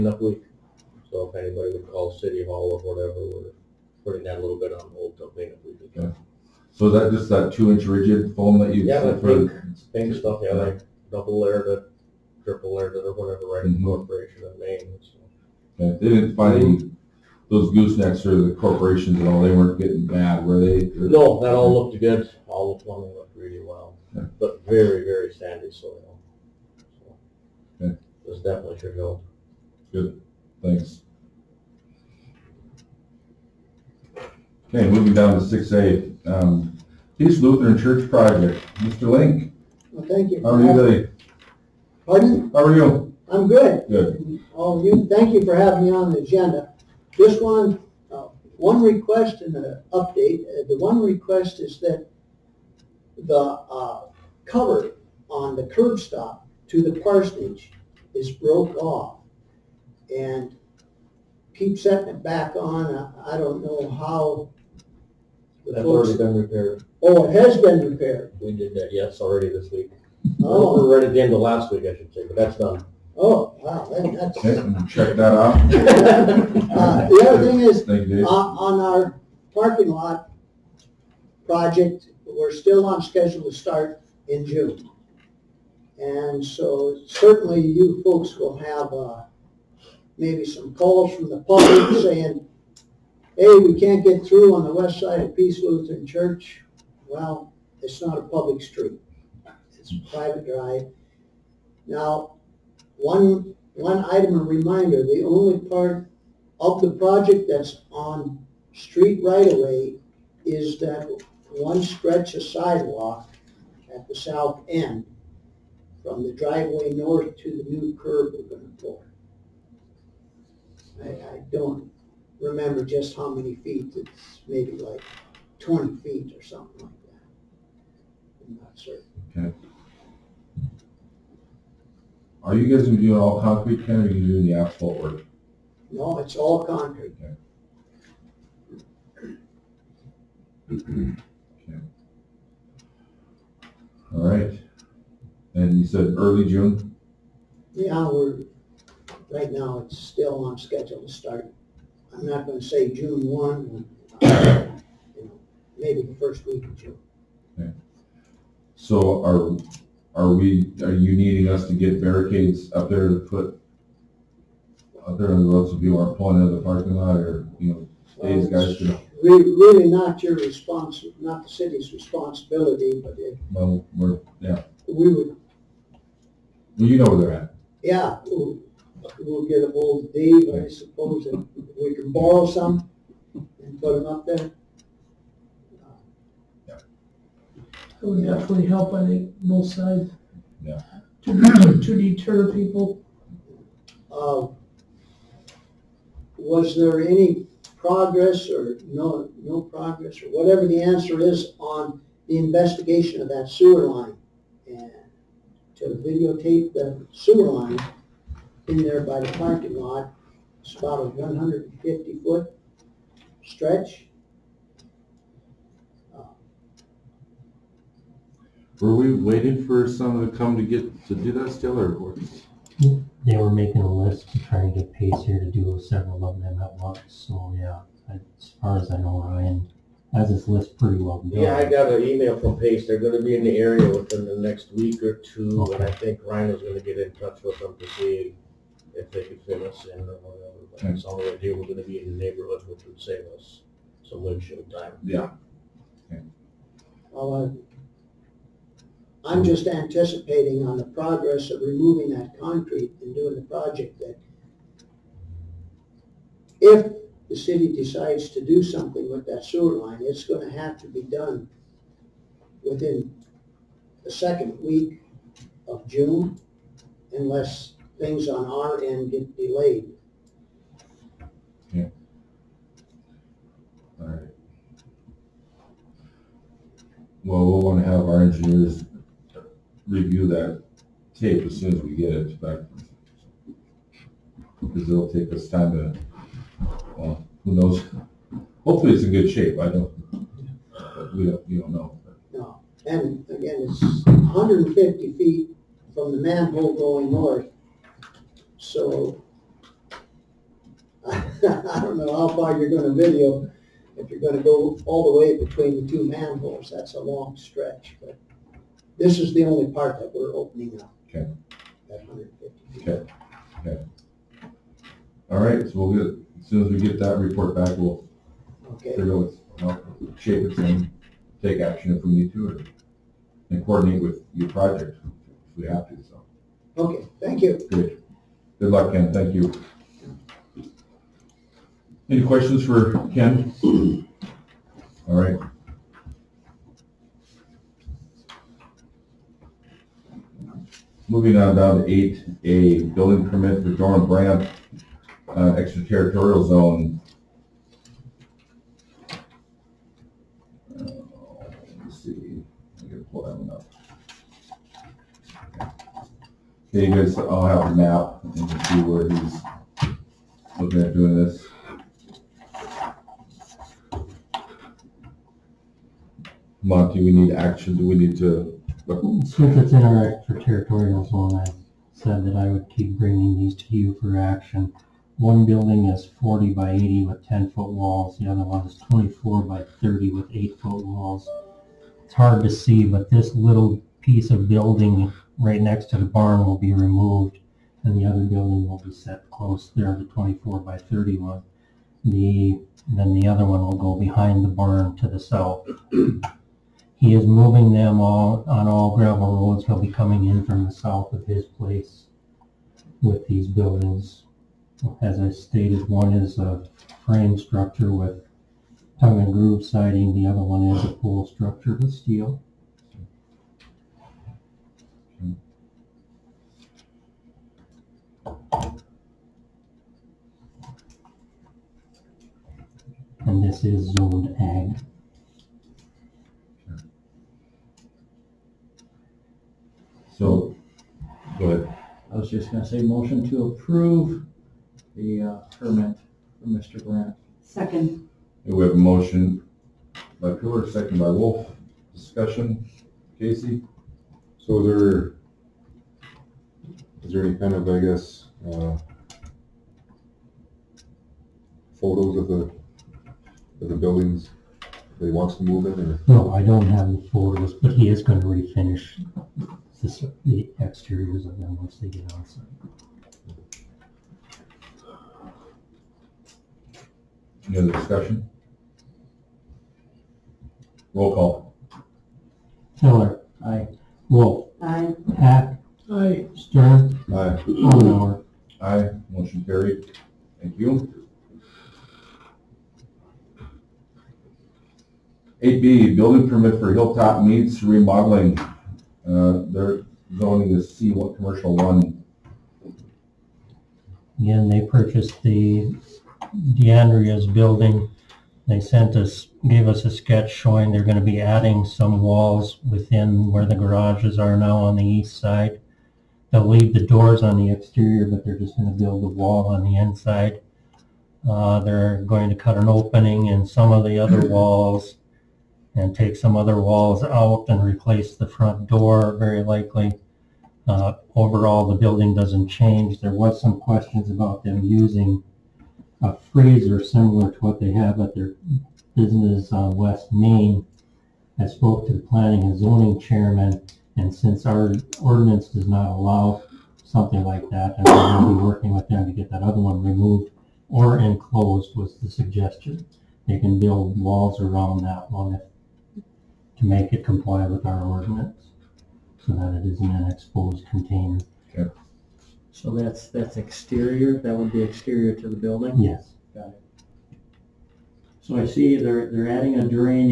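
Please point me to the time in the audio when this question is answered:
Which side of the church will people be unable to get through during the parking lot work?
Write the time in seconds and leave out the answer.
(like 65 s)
94 s.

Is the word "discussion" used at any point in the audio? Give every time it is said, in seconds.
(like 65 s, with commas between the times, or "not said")
441 s, 467 s.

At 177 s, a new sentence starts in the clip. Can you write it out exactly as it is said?
yeah, we'll, we'll get a hold of Dave, I suppose, and we can borrow some and put them up there.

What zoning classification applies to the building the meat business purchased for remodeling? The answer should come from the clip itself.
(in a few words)
C1.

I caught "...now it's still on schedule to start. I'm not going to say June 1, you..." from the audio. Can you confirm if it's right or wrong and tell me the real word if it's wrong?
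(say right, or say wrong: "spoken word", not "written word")
right.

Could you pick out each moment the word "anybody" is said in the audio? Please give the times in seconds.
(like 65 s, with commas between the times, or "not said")
1 s.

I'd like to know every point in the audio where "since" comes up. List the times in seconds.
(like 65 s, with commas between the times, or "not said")
369 s, 534 s.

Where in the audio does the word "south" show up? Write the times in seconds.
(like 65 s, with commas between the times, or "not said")
114 s, 395 s, 400 s.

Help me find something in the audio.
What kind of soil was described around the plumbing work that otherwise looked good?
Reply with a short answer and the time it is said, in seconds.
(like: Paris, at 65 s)
sandy, at 24 s.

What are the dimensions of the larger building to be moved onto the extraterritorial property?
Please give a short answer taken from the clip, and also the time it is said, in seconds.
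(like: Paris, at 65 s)
40 by 80, at 376 s.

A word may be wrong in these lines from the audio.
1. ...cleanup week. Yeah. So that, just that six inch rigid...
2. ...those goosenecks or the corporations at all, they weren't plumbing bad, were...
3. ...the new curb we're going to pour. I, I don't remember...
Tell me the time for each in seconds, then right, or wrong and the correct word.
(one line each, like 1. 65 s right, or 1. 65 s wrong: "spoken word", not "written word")
1. 5 s wrong: "two", not "six"
2. 17 s wrong: "getting", not "plumbing"
3. 117 s right.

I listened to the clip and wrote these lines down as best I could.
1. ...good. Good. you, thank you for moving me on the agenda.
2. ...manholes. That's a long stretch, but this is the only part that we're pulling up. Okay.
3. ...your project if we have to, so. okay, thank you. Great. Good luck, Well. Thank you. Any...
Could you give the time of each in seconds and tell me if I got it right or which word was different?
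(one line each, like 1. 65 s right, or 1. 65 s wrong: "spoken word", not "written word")
1. 43 s wrong: "having", not "moving"
2. 306 s wrong: "opening", not "pulling"
3. 324 s wrong: "Ken", not "Well".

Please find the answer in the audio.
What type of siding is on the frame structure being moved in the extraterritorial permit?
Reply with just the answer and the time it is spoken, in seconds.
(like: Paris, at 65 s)
tongue and groove, at 408 s.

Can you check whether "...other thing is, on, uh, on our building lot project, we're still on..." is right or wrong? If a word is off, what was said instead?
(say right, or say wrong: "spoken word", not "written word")
wrong: "parking", not "building".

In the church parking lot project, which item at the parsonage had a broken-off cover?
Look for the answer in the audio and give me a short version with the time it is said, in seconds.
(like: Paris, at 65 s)
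curb stop, at 55 s.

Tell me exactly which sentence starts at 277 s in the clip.
Well, we'll want to have our engineers review that tape as soon as we get it back.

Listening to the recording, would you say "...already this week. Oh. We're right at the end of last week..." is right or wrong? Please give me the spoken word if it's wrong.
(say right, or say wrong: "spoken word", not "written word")
right.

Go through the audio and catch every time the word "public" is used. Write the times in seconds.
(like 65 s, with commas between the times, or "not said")
91 s, 98 s.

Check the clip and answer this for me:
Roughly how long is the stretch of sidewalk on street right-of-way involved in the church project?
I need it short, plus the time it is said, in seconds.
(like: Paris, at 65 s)
20 feet, at 125 s.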